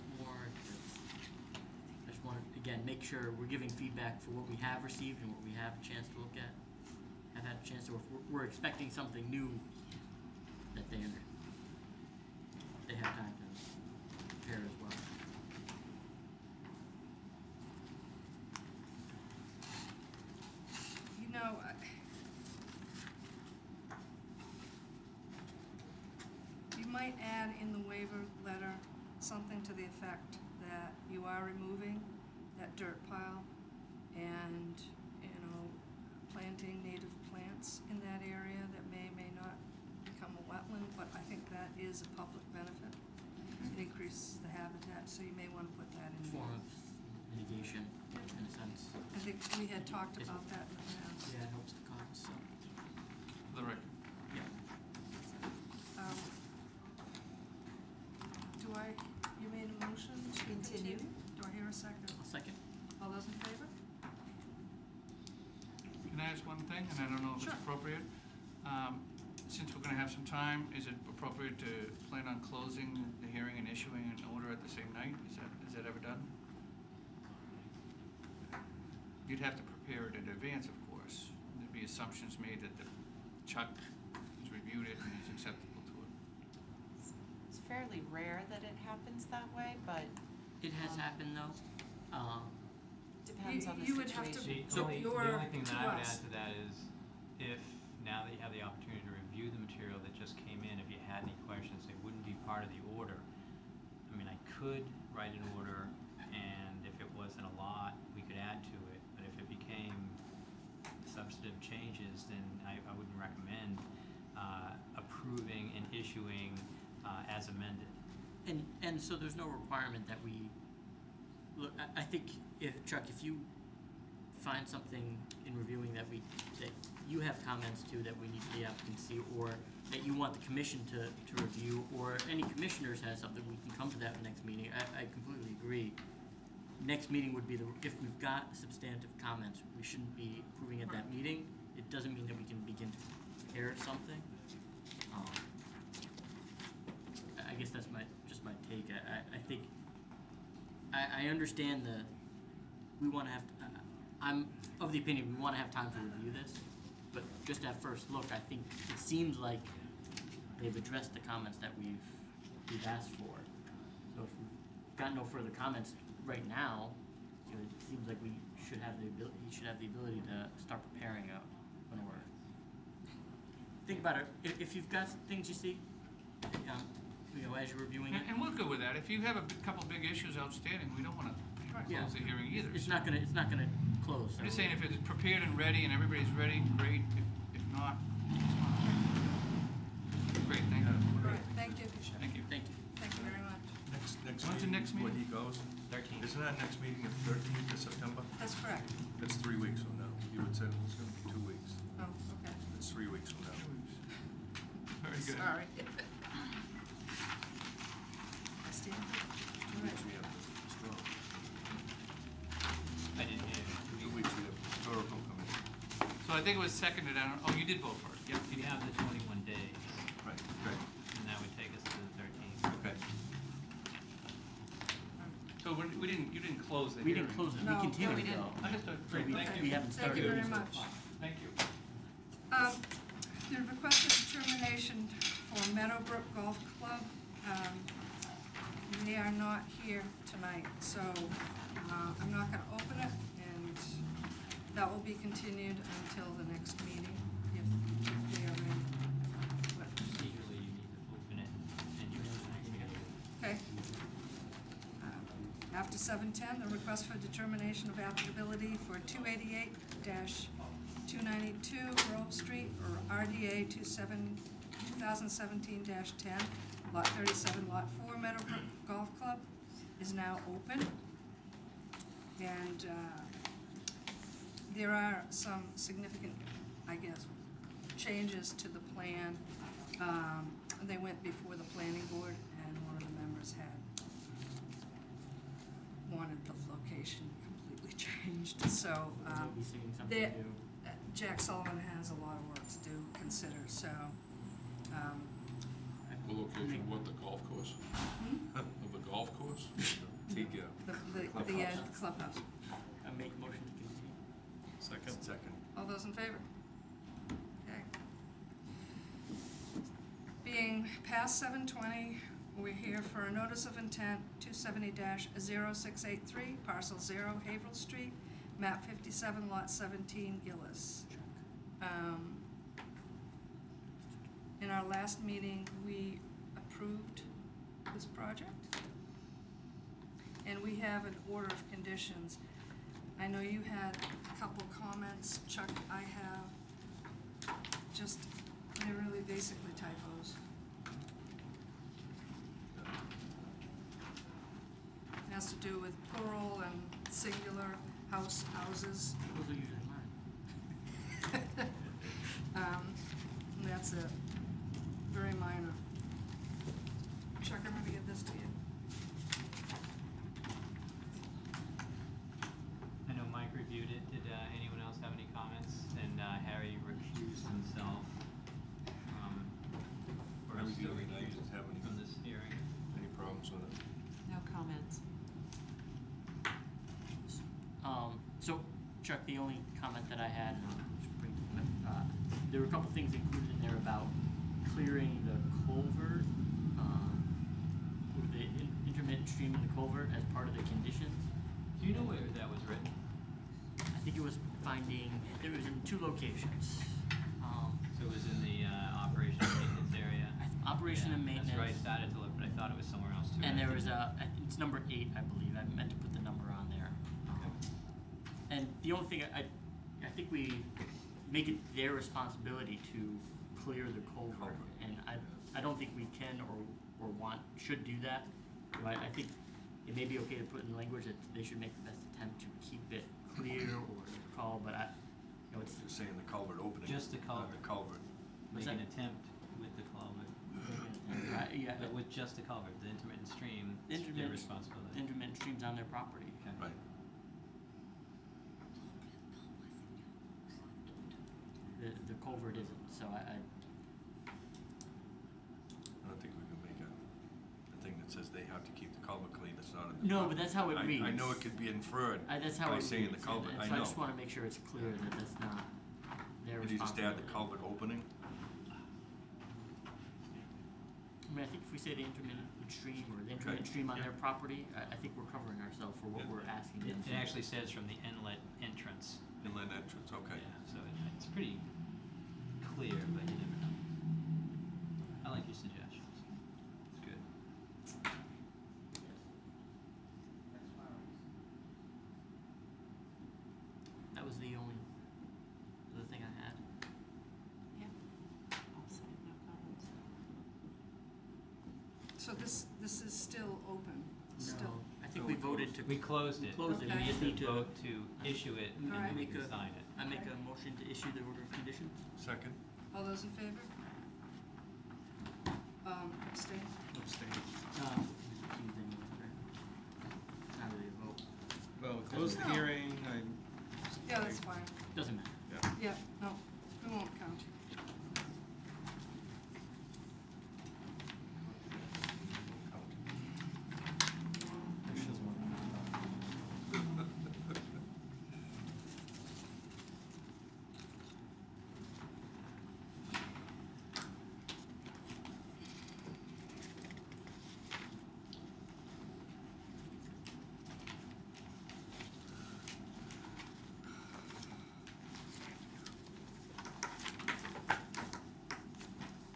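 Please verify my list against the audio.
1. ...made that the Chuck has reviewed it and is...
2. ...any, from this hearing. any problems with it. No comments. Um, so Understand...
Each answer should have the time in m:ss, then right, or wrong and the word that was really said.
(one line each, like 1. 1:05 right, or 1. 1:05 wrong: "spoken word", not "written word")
1. 1:22 right
2. 6:11 wrong: "Chuck", not "Understand".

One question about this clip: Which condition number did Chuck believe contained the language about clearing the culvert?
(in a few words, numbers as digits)
8.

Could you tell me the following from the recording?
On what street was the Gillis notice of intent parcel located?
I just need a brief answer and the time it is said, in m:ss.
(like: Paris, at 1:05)
Haverhill Street, at 5:17.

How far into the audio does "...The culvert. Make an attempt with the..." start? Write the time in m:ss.
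7:07.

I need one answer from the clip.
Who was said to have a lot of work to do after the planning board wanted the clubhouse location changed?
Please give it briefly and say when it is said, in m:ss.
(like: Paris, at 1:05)
Jack Sullivan, at 4:51.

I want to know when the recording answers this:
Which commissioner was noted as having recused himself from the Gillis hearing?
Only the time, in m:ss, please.
6:06.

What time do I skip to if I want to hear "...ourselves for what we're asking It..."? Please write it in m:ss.
7:45.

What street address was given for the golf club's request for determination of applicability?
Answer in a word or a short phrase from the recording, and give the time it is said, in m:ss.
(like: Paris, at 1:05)
288-292 Grove Street, at 4:19.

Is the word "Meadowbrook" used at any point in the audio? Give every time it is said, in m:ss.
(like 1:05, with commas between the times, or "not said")
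3:55, 4:28.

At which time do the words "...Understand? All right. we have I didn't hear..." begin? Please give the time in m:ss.
3:28.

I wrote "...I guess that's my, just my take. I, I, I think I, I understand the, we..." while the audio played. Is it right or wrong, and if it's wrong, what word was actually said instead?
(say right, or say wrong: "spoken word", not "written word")
right.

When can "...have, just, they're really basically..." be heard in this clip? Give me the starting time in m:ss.
5:36.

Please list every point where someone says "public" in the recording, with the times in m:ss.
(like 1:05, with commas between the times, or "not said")
0:42.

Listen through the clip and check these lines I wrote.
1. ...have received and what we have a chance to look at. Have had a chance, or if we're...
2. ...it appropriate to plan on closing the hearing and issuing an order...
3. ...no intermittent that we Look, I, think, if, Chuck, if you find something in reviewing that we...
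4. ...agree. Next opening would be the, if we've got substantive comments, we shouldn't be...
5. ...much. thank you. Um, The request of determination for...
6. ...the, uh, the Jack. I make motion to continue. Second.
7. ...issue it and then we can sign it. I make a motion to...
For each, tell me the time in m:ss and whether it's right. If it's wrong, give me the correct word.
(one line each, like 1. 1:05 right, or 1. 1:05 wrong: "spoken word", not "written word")
1. 0:04 right
2. 1:10 right
3. 1:59 wrong: "requirement", not "intermittent"
4. 2:15 wrong: "meeting", not "opening"
5. 3:50 right
6. 5:00 wrong: "Clubhouse", not "Jack"
7. 8:18 right.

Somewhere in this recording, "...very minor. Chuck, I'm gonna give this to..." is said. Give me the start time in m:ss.
5:55.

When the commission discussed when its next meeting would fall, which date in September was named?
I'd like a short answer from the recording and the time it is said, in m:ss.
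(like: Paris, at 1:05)
September 13, at 3:17.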